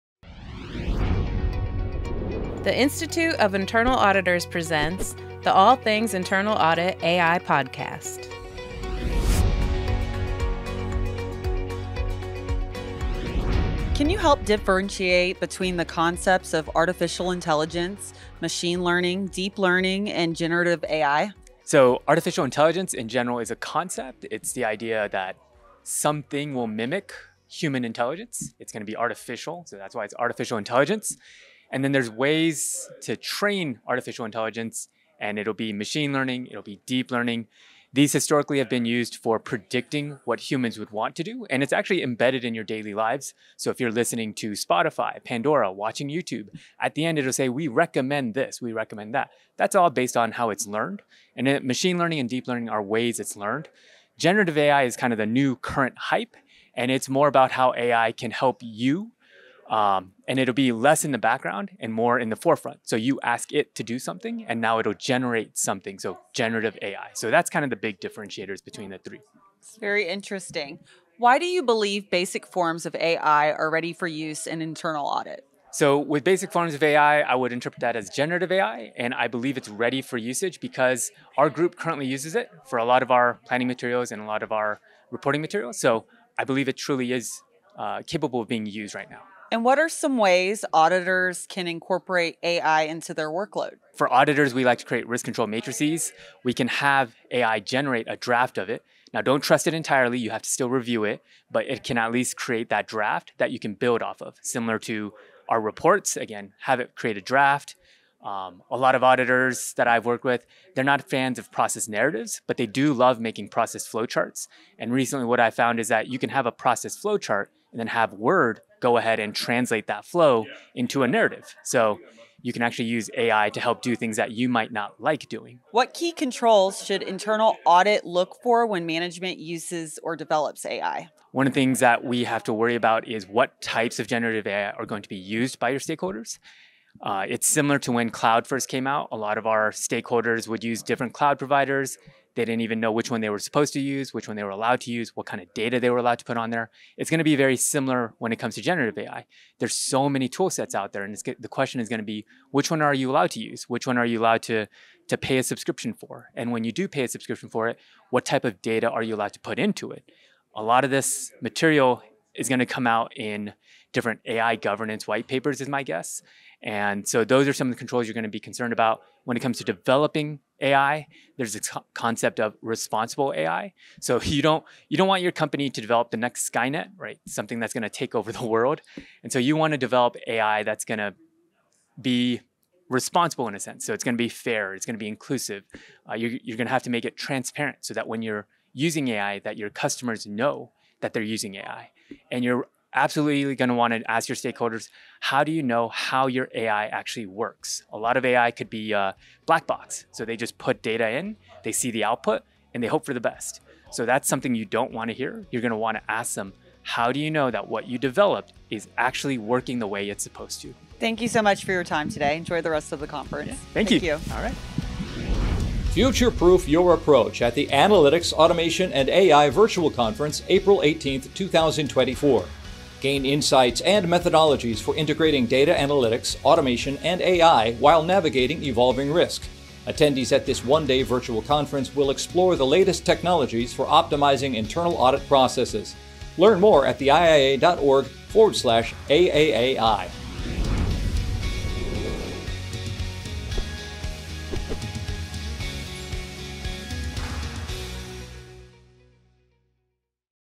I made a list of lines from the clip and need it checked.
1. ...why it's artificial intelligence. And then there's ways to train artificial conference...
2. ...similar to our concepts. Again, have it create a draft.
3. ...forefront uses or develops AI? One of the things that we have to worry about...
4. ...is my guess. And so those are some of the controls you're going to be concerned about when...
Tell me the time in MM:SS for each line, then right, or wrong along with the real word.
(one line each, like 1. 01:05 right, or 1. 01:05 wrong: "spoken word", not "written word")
1. 00:29 wrong: "intelligence", not "conference"
2. 01:44 wrong: "reports", not "concepts"
3. 02:08 wrong: "management", not "forefront"
4. 02:45 right.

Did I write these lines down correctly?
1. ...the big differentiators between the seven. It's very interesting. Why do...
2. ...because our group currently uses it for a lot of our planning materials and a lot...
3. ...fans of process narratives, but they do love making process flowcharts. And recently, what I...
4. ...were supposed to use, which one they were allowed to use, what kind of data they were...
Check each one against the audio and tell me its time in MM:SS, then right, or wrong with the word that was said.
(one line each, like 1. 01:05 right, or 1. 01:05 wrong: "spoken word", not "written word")
1. 01:07 wrong: "three", not "seven"
2. 01:20 right
3. 01:51 right
4. 02:23 right.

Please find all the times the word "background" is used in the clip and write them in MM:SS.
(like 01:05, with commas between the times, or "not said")
01:01.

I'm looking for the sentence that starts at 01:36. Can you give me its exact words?
We can have AI generate a draft of it.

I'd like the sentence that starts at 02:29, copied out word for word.
There's so many tool sets out there, and the question is going to be which one are you allowed to use?